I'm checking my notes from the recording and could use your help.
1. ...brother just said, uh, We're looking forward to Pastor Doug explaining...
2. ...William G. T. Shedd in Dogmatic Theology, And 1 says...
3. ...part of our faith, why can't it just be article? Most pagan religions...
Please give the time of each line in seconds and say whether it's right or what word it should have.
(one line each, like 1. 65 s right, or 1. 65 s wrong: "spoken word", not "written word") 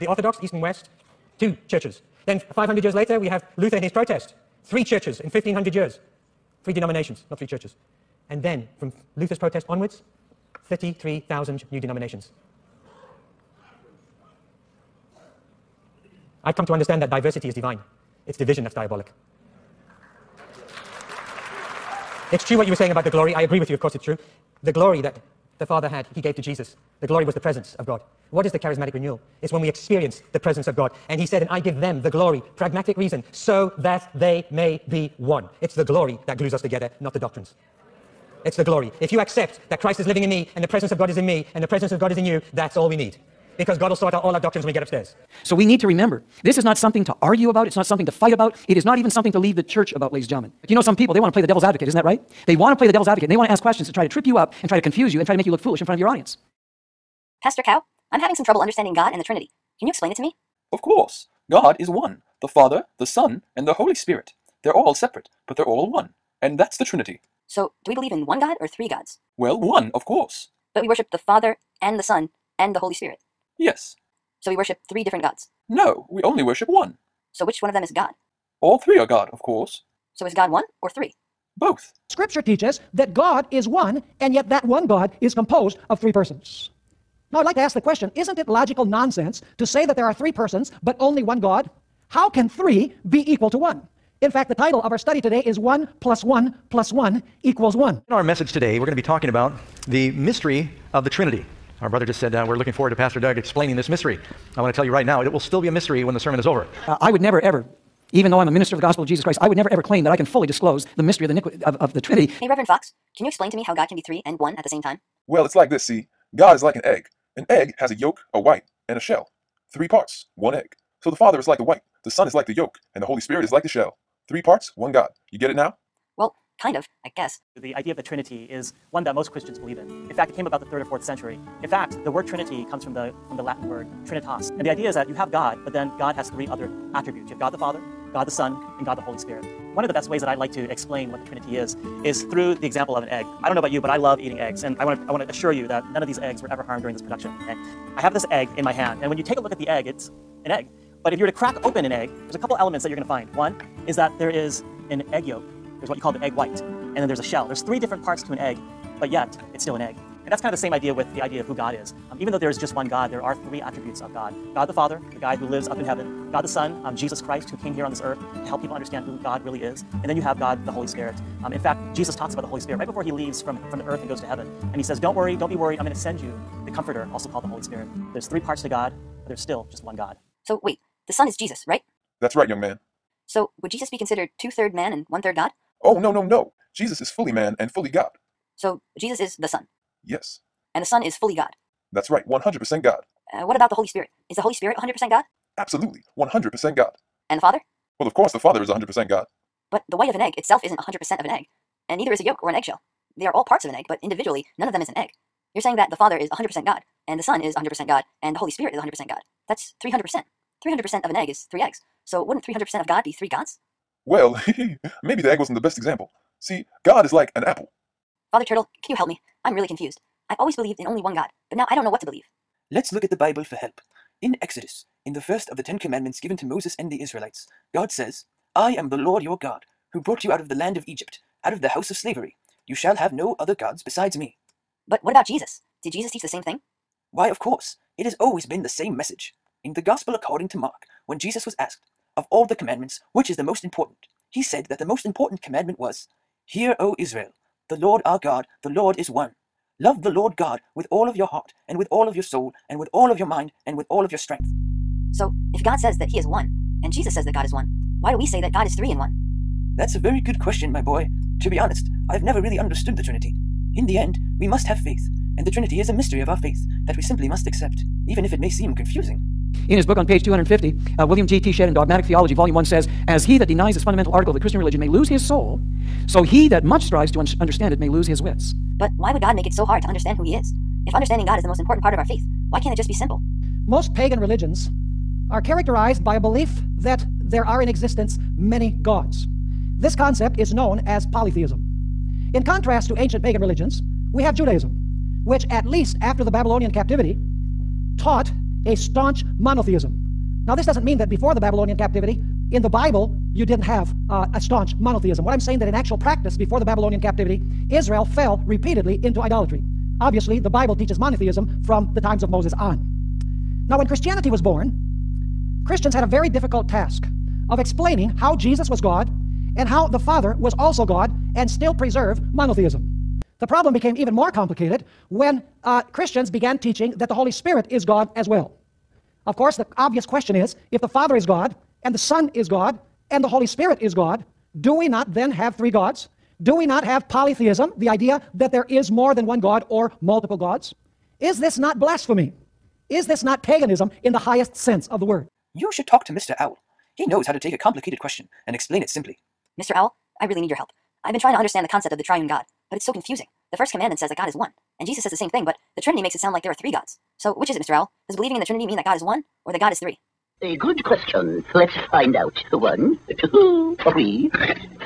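1. 101 s right
2. 271 s wrong: "Volume", not "And"
3. 281 s wrong: "simple", not "article".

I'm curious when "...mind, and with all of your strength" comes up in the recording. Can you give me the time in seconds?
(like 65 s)
253 s.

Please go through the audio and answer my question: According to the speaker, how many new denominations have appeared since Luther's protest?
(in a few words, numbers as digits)
33,000.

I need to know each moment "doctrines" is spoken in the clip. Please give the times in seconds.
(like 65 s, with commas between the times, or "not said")
37 s, 44 s.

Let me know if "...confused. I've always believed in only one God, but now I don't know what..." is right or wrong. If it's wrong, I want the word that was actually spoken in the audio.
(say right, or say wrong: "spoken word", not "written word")
right.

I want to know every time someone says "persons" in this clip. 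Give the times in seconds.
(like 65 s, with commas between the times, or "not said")
86 s, 90 s.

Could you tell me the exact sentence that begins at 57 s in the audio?
Pastor Cow, I'm having some trouble understanding God and the Trinity.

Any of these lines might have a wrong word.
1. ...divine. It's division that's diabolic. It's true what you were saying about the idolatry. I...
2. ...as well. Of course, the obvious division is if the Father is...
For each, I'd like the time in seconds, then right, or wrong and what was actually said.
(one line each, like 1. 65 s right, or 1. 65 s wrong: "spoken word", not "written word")
1. 17 s wrong: "glory", not "idolatry"
2. 328 s wrong: "question", not "division".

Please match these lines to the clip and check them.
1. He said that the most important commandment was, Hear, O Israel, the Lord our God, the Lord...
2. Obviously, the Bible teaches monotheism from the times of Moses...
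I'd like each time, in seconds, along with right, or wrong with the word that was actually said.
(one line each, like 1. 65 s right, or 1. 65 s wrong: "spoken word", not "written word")
1. 244 s right
2. 310 s right.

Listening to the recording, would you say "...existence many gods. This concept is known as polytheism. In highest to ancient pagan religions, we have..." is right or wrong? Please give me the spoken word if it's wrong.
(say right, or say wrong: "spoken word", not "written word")
wrong: "contrast", not "highest".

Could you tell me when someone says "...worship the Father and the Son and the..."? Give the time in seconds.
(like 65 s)
70 s.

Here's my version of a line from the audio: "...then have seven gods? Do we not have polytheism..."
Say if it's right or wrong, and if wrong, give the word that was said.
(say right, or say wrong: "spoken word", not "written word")
wrong: "three", not "seven".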